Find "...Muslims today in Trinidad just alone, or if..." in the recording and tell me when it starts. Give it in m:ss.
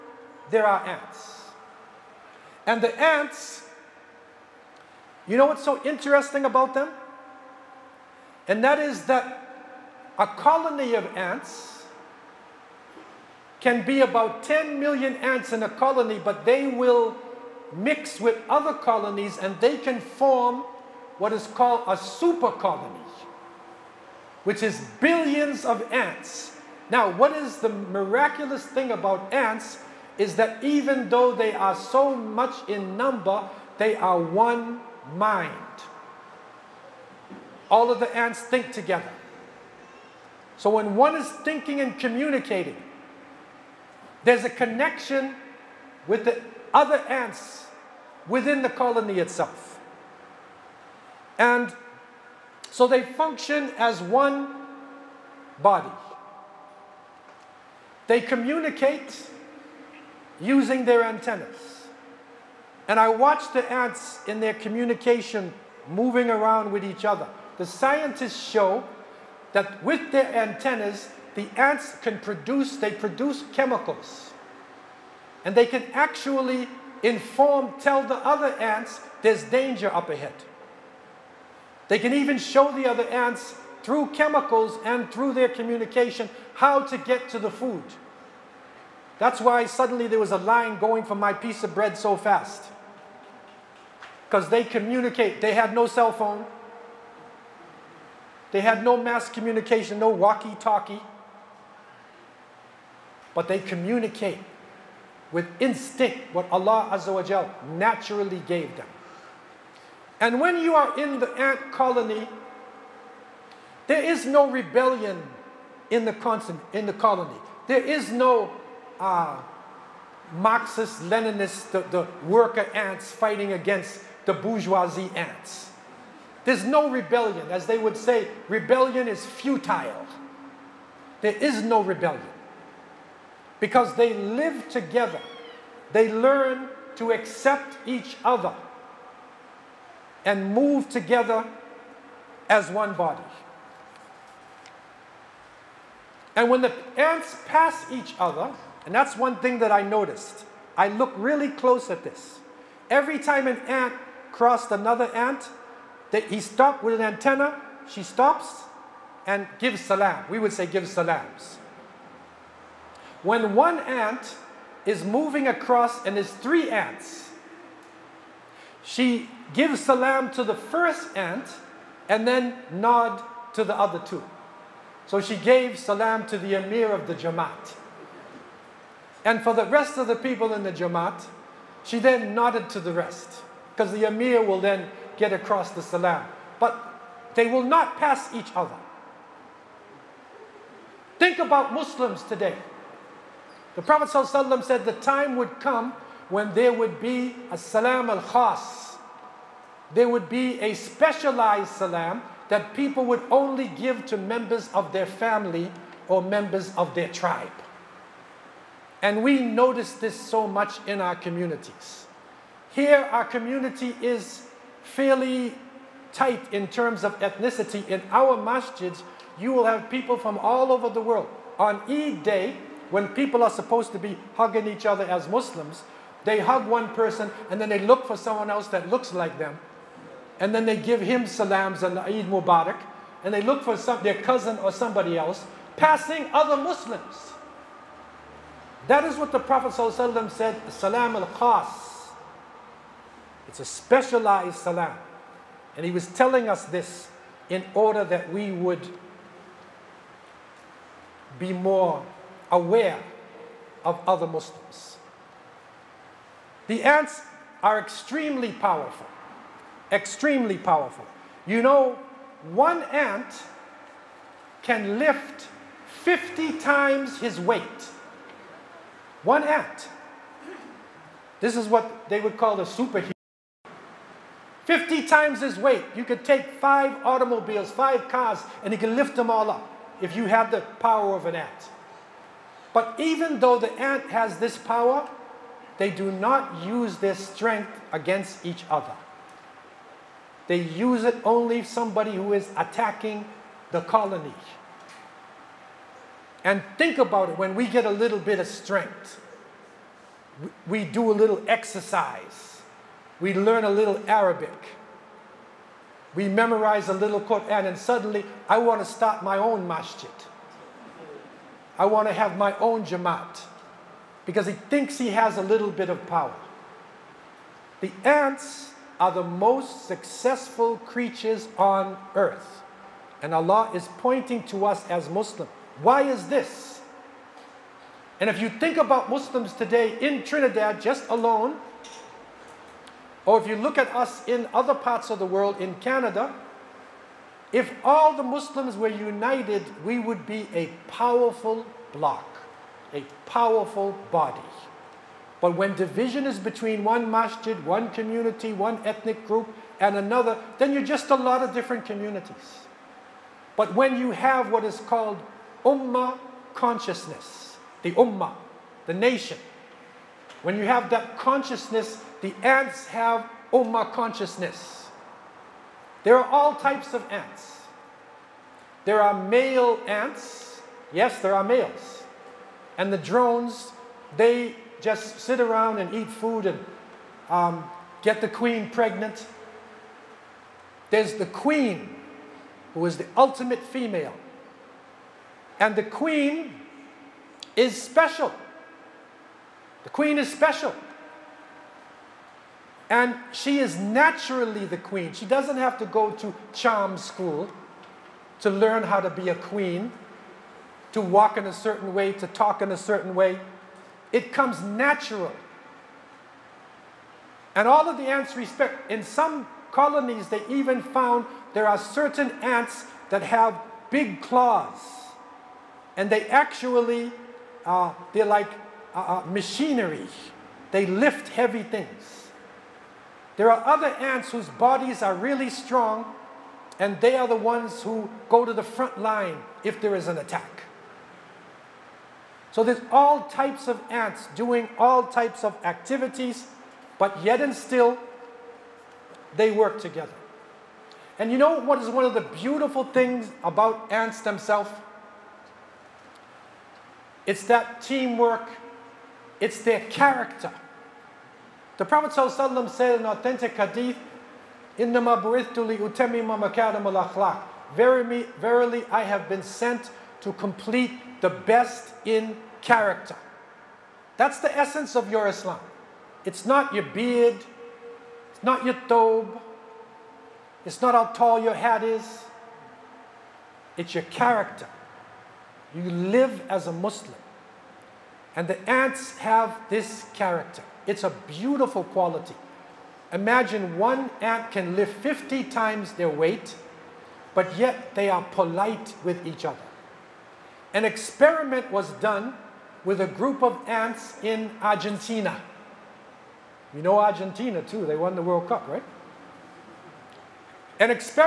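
5:29.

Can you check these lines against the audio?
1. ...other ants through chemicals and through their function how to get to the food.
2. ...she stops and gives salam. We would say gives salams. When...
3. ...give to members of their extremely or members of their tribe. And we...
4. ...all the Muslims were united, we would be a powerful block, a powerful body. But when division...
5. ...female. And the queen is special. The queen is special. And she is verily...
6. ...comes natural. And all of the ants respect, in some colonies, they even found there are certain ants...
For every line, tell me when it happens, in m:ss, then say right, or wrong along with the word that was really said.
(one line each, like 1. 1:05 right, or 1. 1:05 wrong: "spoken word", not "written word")
1. 1:22 wrong: "communication", not "function"
2. 2:37 right
3. 3:23 wrong: "family", not "extremely"
4. 5:37 right
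5. 6:23 wrong: "naturally", not "verily"
6. 6:44 right.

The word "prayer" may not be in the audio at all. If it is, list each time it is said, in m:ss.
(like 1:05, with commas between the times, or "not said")
not said.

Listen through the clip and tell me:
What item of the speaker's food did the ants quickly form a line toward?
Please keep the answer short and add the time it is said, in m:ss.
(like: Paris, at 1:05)
piece of bread, at 1:31.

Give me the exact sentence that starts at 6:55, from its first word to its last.
And they actually, uh, they're like uh, uh, machinery.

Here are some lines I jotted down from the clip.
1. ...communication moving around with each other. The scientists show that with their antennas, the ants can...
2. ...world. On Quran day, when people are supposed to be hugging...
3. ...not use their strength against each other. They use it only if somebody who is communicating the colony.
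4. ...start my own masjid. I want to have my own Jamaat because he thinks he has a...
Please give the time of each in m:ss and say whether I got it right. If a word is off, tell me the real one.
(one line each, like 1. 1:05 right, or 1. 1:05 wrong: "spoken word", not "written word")
1. 1:04 right
2. 3:40 wrong: "Eid", not "Quran"
3. 4:46 wrong: "attacking", not "communicating"
4. 5:08 right.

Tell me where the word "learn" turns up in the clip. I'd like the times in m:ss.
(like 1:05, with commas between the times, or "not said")
2:16, 5:03, 6:38.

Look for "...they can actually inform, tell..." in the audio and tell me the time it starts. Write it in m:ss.
1:15.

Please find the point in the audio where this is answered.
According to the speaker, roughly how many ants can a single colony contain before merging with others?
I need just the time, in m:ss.
0:14.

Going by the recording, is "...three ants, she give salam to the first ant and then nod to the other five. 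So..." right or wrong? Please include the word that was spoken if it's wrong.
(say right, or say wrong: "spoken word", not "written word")
wrong: "two", not "five".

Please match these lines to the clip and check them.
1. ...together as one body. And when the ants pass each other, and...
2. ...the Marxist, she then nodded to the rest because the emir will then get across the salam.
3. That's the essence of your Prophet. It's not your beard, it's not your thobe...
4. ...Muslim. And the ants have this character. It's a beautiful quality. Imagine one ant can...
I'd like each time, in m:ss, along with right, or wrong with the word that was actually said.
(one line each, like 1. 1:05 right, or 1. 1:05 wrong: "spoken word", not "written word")
1. 2:20 right
2. 3:00 wrong: "Jamaat", not "Marxist"
3. 7:44 wrong: "Islam", not "Prophet"
4. 7:56 right.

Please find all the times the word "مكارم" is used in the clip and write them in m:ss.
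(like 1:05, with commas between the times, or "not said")
7:36.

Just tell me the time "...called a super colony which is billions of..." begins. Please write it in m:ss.
0:21.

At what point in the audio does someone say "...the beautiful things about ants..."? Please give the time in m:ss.
7:22.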